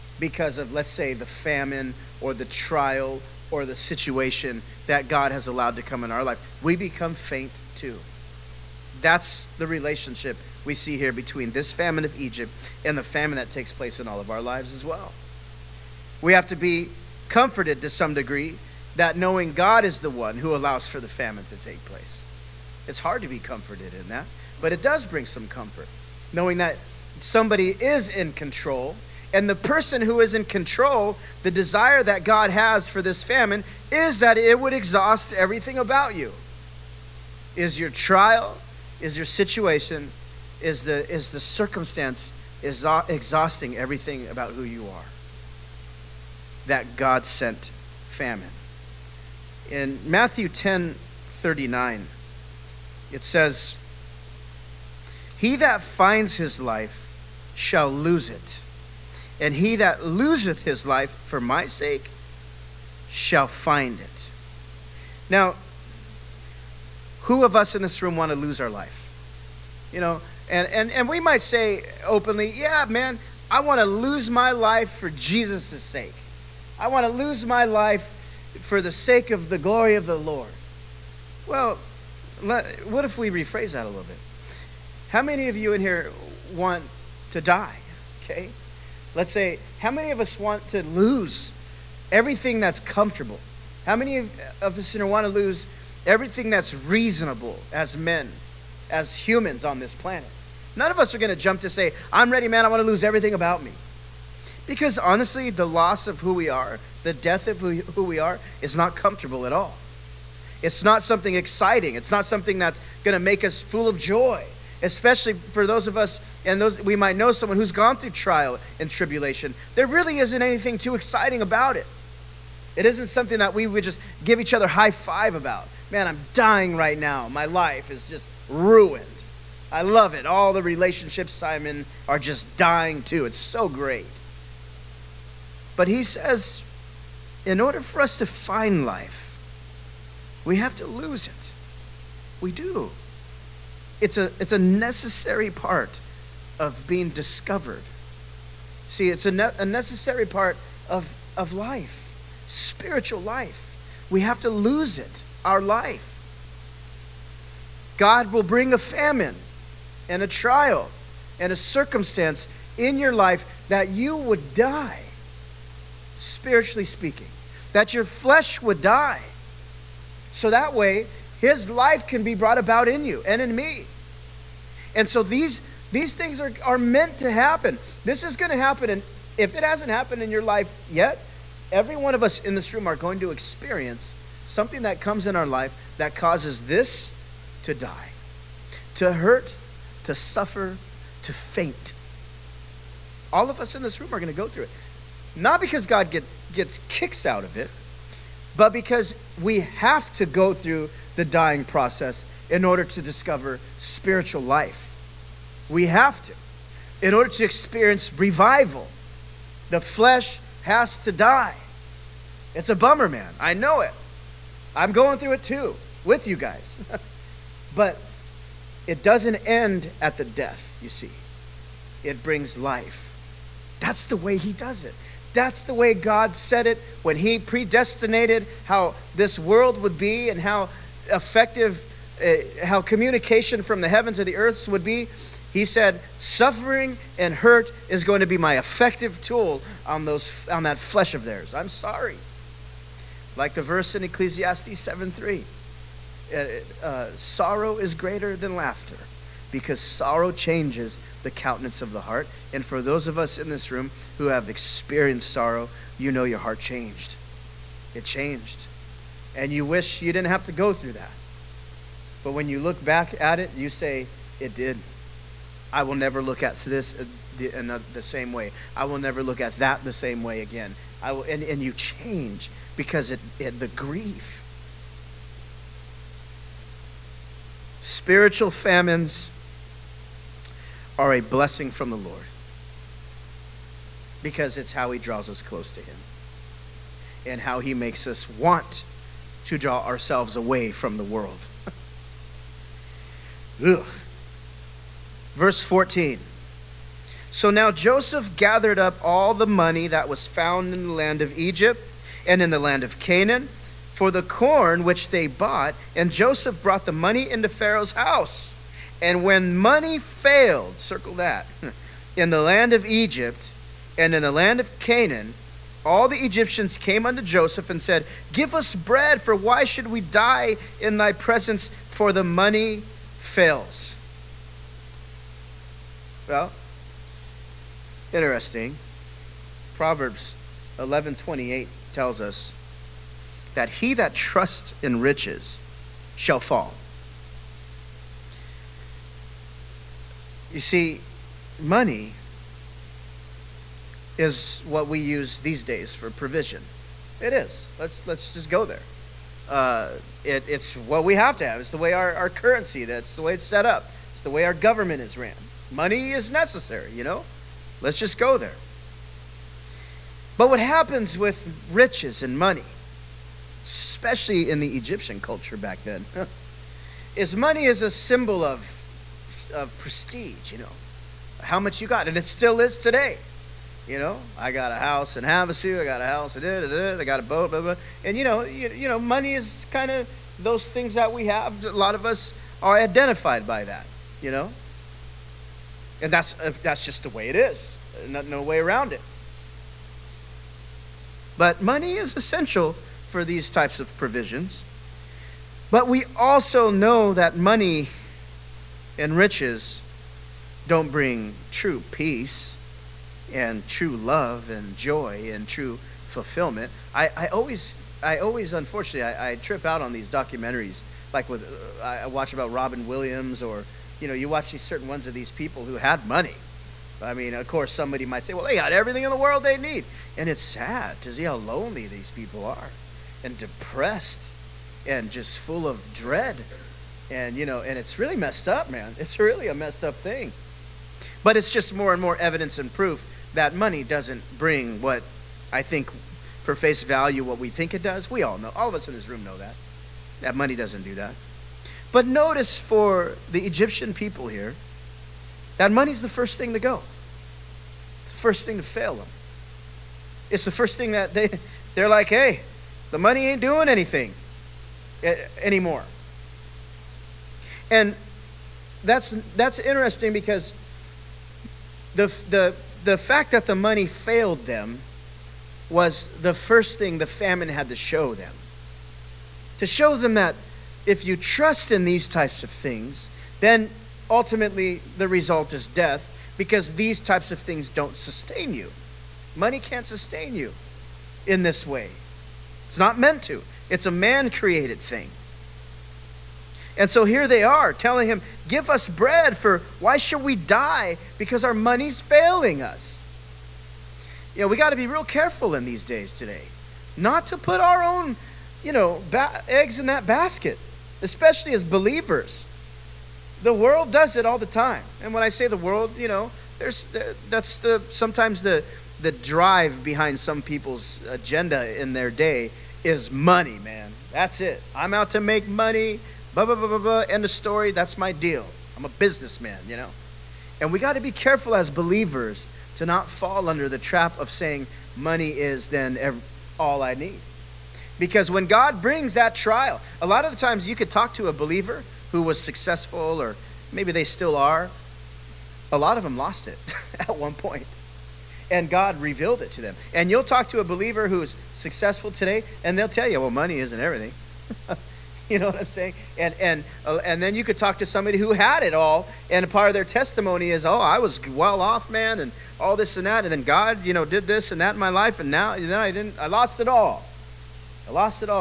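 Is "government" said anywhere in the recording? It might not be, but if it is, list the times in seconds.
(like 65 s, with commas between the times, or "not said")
354 s.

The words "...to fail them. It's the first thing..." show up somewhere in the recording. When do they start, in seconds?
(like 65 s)
448 s.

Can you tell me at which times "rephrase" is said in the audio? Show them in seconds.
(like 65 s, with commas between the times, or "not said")
83 s.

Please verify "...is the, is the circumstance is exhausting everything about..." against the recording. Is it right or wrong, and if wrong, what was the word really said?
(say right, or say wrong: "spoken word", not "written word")
right.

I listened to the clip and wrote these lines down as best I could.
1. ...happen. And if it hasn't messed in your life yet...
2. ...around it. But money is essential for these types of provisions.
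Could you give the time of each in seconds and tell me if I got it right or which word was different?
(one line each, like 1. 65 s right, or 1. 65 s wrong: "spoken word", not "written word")
1. 178 s wrong: "happened", not "messed"
2. 388 s right.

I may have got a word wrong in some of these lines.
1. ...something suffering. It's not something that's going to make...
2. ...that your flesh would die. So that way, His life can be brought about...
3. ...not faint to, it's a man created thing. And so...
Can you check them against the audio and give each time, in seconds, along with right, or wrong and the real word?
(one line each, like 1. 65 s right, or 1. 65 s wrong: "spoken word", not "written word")
1. 111 s wrong: "exciting", not "suffering"
2. 167 s right
3. 482 s wrong: "meant", not "faint".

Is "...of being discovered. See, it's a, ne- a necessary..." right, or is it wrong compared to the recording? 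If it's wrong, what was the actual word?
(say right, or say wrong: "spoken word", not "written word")
right.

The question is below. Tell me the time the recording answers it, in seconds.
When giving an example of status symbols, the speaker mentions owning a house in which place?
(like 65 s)
375 s.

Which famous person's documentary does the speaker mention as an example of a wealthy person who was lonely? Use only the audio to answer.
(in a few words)
Robin Williams.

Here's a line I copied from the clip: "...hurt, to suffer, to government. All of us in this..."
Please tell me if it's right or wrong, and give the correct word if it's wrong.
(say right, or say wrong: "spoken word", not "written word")
wrong: "faint", not "government".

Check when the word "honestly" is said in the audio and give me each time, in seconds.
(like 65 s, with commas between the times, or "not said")
104 s.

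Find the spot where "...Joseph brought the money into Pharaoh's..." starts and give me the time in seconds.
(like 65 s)
306 s.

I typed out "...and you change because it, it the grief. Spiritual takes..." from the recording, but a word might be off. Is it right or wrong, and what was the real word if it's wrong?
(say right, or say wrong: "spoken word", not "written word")
wrong: "famines", not "takes".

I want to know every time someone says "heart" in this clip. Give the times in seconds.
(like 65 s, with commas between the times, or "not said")
252 s, 256 s.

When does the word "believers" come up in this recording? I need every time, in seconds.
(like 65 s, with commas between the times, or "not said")
501 s, 521 s, 531 s, 540 s.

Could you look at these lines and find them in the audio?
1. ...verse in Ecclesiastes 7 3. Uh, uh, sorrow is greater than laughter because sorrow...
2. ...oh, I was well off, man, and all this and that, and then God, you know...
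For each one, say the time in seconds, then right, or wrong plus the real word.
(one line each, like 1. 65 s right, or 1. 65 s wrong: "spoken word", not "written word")
1. 243 s right
2. 550 s right.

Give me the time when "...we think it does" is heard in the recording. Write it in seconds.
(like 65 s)
437 s.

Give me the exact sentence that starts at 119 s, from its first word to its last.
There really isn't anything too exciting about it.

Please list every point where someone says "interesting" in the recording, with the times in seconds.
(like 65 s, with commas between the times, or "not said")
328 s, 459 s.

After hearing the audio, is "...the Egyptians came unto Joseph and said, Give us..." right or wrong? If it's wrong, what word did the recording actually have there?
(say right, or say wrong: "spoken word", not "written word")
right.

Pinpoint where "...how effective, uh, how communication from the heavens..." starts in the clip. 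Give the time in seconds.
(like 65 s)
230 s.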